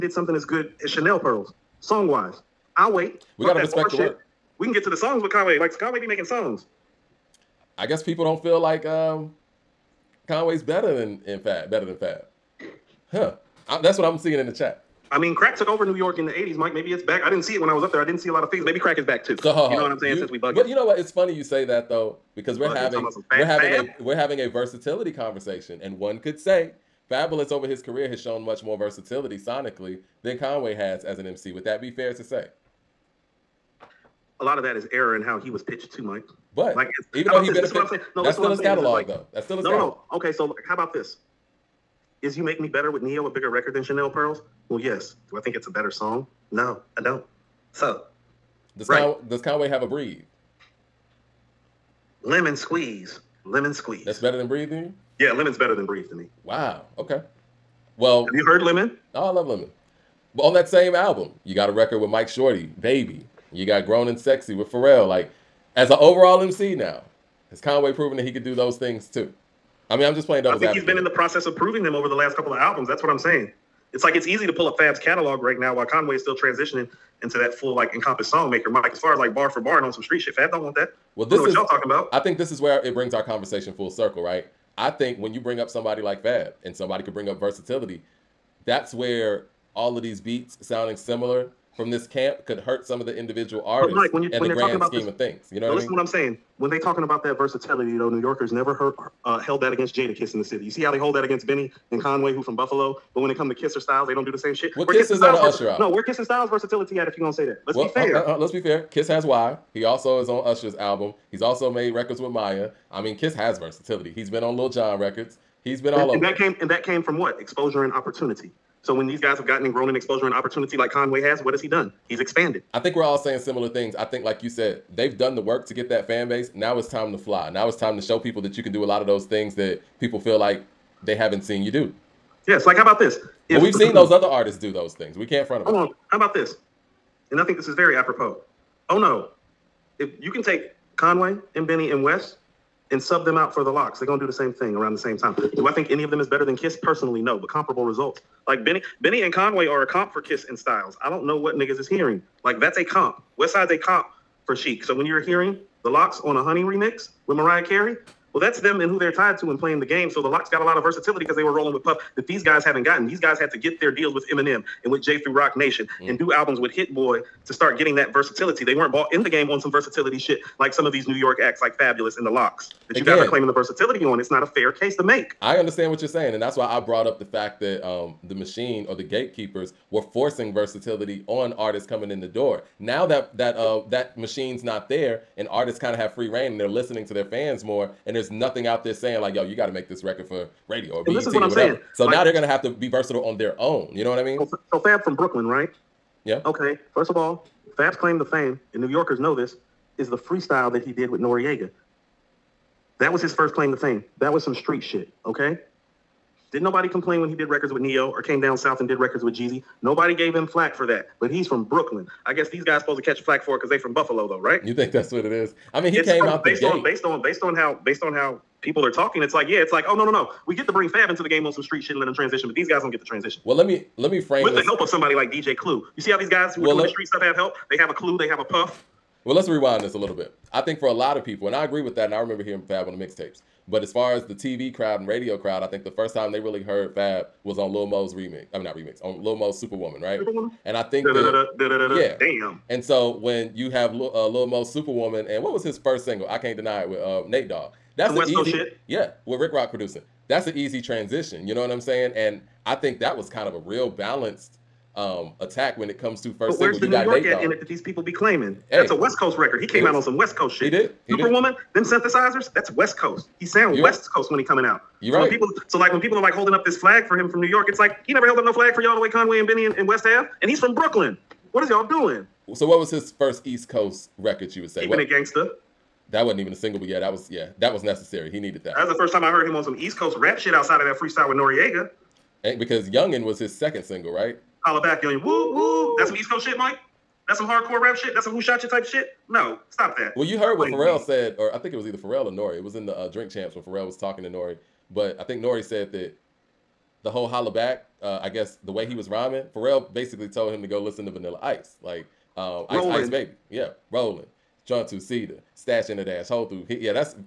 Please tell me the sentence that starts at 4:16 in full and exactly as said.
the you New York in it that these people be claiming?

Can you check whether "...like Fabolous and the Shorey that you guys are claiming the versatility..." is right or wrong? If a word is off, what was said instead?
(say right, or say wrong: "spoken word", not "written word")
wrong: "LOX", not "Shorey".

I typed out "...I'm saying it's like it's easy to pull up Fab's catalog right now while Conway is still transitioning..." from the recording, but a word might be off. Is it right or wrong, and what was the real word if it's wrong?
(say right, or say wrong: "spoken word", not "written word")
right.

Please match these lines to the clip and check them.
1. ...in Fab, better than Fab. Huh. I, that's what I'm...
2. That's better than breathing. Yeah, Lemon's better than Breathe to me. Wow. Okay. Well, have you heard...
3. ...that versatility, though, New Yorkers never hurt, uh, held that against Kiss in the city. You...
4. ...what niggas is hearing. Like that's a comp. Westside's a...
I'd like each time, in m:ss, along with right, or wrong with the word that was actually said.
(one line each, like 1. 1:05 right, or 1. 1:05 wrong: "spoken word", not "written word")
1. 0:11 right
2. 0:54 right
3. 1:37 right
4. 2:31 right.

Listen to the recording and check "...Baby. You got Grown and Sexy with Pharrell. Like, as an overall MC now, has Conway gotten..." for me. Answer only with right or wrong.
wrong.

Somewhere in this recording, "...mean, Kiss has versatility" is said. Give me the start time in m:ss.
1:52.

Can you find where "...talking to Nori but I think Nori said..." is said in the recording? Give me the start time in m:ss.
4:53.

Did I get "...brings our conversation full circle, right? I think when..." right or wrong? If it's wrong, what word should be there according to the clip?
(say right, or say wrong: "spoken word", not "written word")
right.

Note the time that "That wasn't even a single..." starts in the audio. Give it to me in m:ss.
4:36.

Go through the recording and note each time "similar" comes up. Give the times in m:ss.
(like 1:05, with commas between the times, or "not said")
1:30, 2:03.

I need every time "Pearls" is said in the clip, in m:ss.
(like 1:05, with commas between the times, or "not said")
0:01, 0:44.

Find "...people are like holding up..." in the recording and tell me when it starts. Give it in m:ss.
4:25.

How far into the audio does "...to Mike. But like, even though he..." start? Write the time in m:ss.
0:35.